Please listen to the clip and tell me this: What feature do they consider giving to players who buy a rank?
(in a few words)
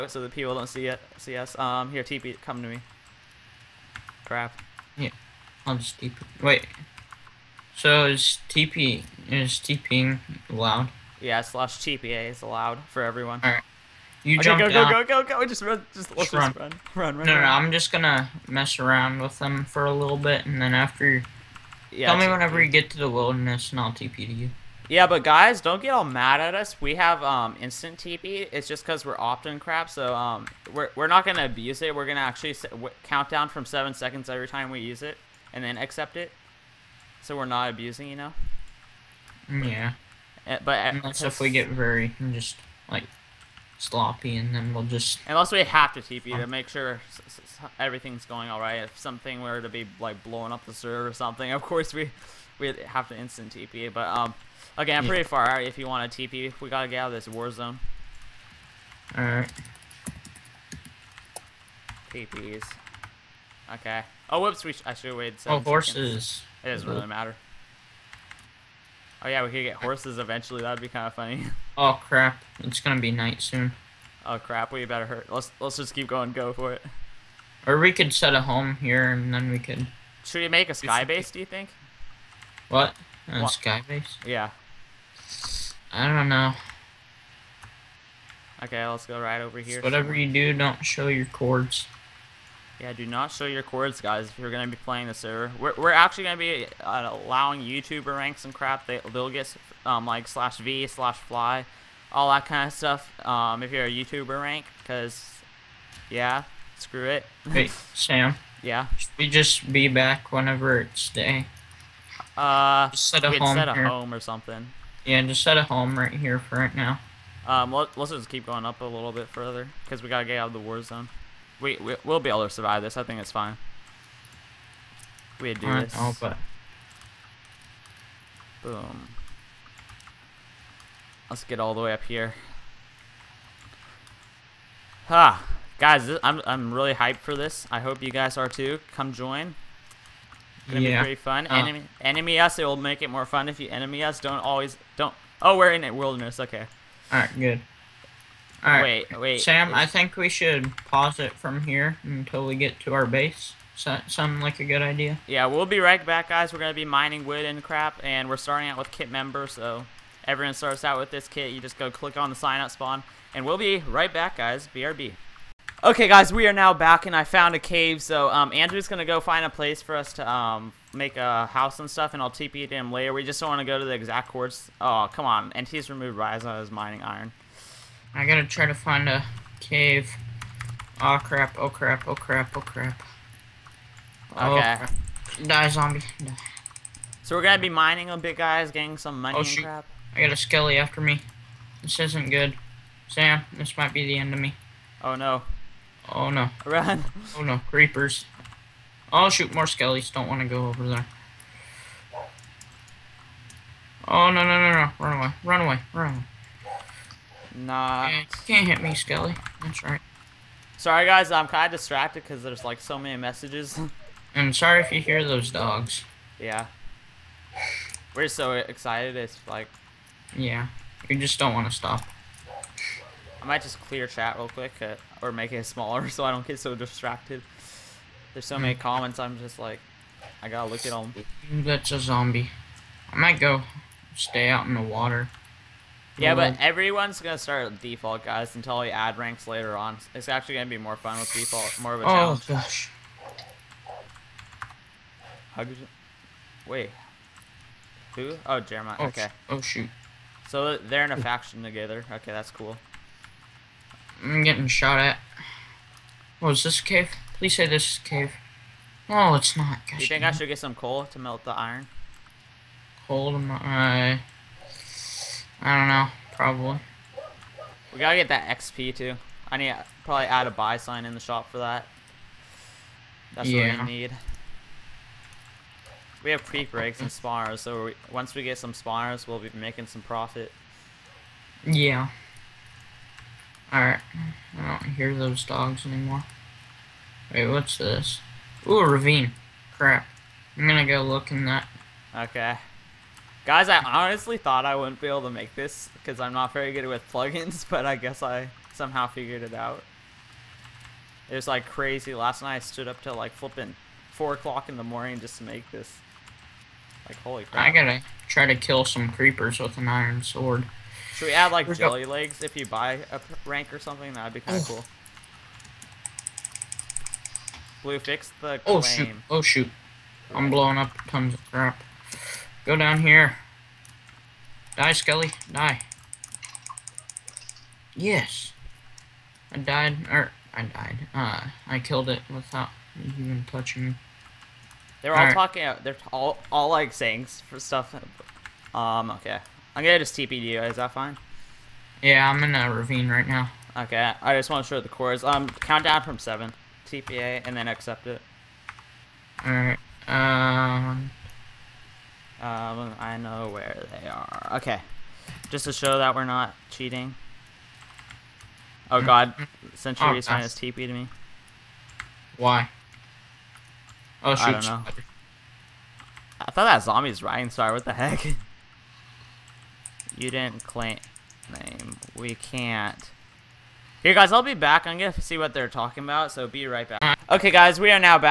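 jelly legs.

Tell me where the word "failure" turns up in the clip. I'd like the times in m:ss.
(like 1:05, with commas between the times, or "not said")
not said.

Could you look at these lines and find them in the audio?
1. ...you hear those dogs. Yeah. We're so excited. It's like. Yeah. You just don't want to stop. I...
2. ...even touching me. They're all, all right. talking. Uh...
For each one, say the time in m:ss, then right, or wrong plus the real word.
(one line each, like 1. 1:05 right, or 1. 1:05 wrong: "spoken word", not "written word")
1. 3:34 right
2. 5:32 right.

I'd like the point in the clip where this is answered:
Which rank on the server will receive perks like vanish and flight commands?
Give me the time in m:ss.
1:37.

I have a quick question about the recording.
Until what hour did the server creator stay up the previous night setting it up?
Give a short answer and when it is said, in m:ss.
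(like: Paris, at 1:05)
4 o'clock, at 5:04.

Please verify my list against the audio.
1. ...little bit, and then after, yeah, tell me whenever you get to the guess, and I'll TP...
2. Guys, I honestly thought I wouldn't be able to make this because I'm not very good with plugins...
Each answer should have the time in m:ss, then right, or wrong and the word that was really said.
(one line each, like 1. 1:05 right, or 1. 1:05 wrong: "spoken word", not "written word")
1. 0:19 wrong: "wilderness", not "guess"
2. 4:53 right.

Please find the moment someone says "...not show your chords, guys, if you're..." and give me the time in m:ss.
1:33.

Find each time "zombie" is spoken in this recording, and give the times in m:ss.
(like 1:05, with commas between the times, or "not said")
3:05, 3:51, 6:06.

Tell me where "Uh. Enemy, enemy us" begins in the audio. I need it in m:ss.
2:21.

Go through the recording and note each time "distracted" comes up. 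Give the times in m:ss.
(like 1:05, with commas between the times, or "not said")
3:31, 3:46.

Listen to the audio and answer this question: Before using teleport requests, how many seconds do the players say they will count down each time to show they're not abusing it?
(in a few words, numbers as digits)
7.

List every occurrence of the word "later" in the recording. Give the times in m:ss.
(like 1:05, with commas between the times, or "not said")
2:52, 3:59.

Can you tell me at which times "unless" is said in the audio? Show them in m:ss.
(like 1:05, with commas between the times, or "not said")
0:40, 0:45.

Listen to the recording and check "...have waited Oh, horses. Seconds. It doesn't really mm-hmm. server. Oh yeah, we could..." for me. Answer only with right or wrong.
wrong.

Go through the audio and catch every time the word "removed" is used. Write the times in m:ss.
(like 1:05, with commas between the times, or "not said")
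2:55.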